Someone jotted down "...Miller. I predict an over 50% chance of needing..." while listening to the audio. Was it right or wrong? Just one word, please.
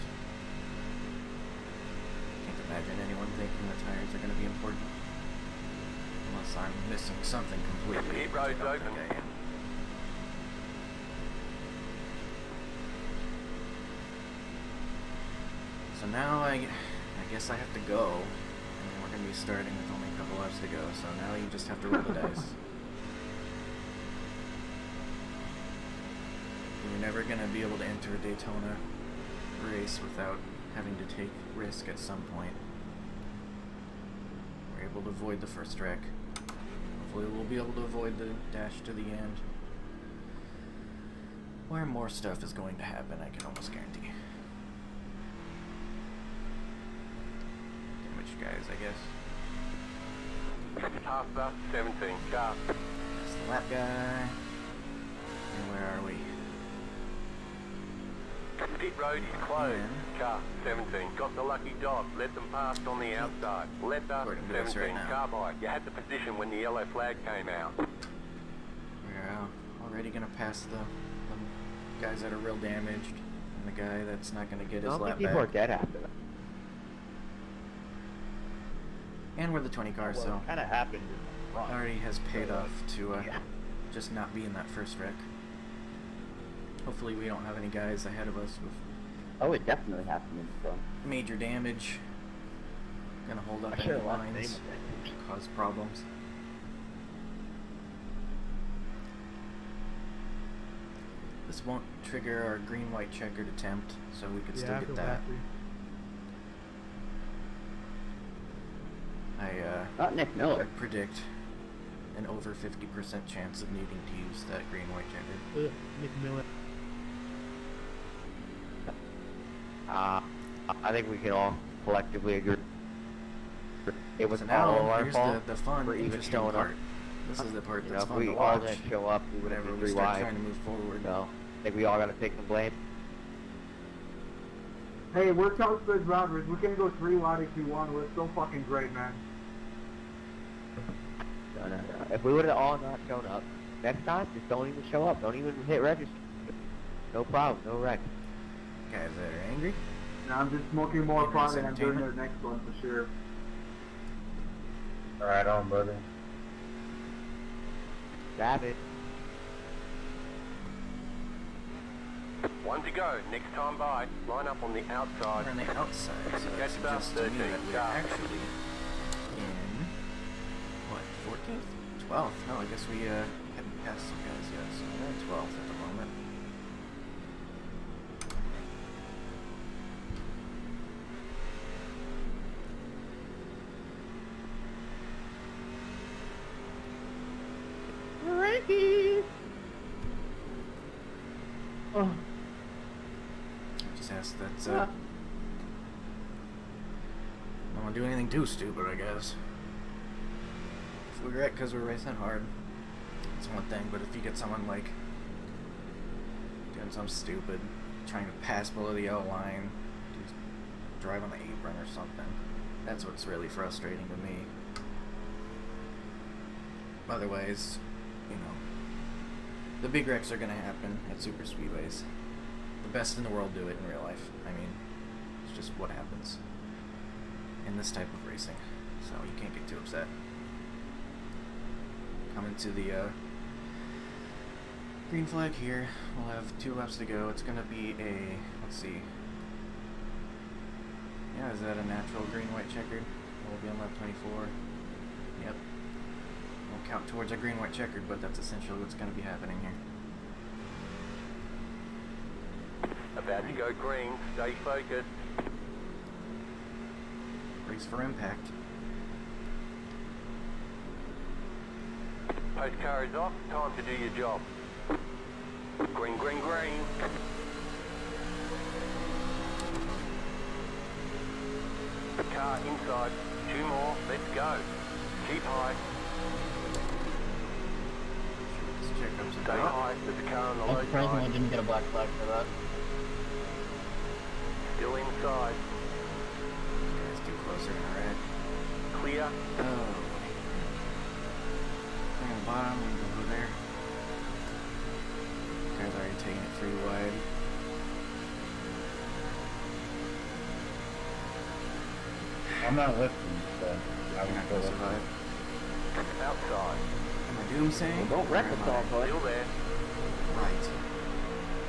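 right.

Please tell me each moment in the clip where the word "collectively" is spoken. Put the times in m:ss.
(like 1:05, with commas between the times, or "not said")
2:01.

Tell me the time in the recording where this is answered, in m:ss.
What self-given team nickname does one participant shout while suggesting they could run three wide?
2:15.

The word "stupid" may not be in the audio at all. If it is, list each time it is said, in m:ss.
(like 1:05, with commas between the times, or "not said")
3:18, 3:27.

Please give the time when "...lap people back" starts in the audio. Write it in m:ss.
1:14.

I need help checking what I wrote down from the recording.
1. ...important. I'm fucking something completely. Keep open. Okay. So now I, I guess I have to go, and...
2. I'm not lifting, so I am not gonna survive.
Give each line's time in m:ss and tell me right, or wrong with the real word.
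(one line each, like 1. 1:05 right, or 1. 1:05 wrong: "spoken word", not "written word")
1. 0:04 wrong: "missing", not "fucking"
2. 5:02 right.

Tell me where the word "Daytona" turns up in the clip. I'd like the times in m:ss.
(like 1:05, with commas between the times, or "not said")
0:28.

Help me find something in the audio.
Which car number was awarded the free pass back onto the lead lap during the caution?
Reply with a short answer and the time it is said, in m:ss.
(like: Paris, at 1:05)
17, at 1:00.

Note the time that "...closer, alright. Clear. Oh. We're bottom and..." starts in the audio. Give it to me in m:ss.
4:47.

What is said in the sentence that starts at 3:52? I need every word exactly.
Coming to the uh, green flag here.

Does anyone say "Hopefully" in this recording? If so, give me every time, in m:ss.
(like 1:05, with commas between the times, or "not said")
0:37, 1:26.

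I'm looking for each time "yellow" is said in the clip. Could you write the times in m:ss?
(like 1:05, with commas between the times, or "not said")
1:06, 3:29.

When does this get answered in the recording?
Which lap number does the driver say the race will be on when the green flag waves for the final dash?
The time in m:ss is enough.
4:03.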